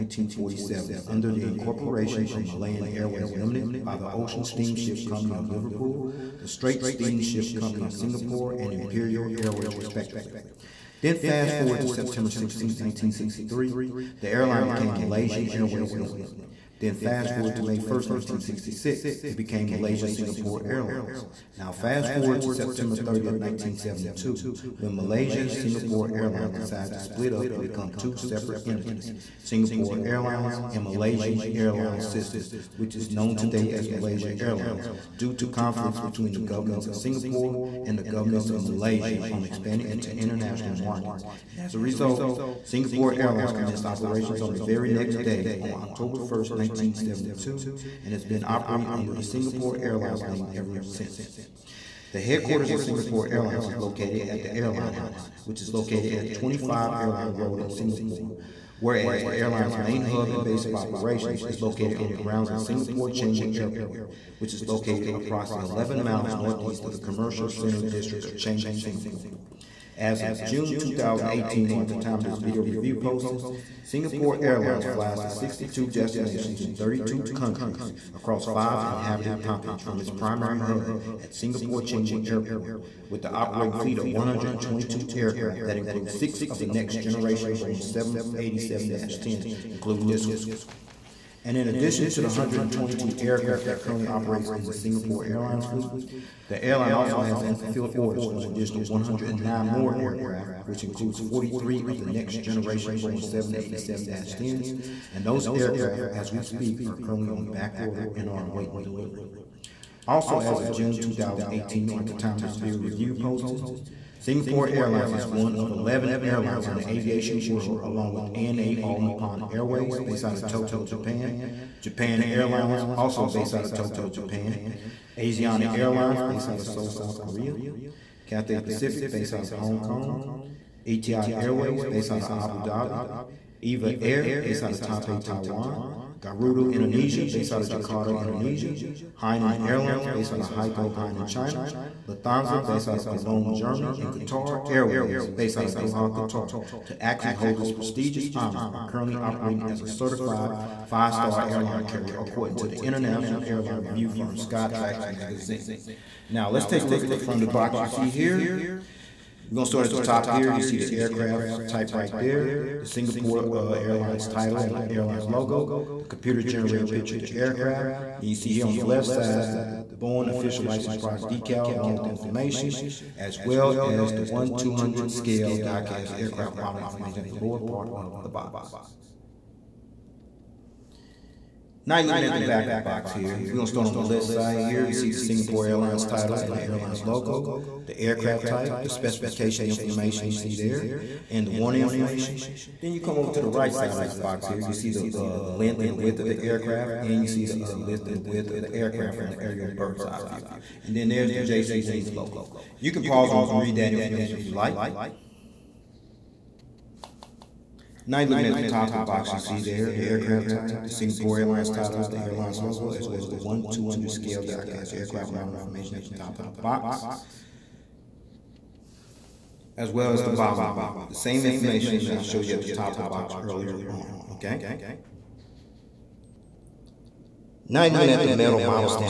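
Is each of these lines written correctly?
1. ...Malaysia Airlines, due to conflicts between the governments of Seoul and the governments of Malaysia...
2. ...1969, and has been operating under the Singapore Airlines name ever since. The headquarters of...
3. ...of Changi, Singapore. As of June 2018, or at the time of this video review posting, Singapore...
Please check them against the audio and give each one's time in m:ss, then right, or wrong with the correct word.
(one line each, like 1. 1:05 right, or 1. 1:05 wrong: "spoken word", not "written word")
1. 0:33 wrong: "Singapore", not "Seoul"
2. 0:46 wrong: "1972", not "1969"
3. 1:08 right.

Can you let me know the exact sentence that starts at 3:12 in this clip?
Then you come over to the right side of this box here.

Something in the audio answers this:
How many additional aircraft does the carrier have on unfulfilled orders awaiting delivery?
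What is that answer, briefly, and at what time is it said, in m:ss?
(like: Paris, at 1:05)
109, at 1:38.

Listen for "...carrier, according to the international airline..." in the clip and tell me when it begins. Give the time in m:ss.
2:31.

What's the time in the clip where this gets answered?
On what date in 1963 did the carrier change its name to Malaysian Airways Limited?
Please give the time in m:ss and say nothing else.
0:11.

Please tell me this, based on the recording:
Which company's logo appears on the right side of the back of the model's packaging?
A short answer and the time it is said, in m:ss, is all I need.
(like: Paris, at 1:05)
JC Wings, at 3:21.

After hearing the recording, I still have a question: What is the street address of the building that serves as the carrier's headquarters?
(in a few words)
25 Airline Road.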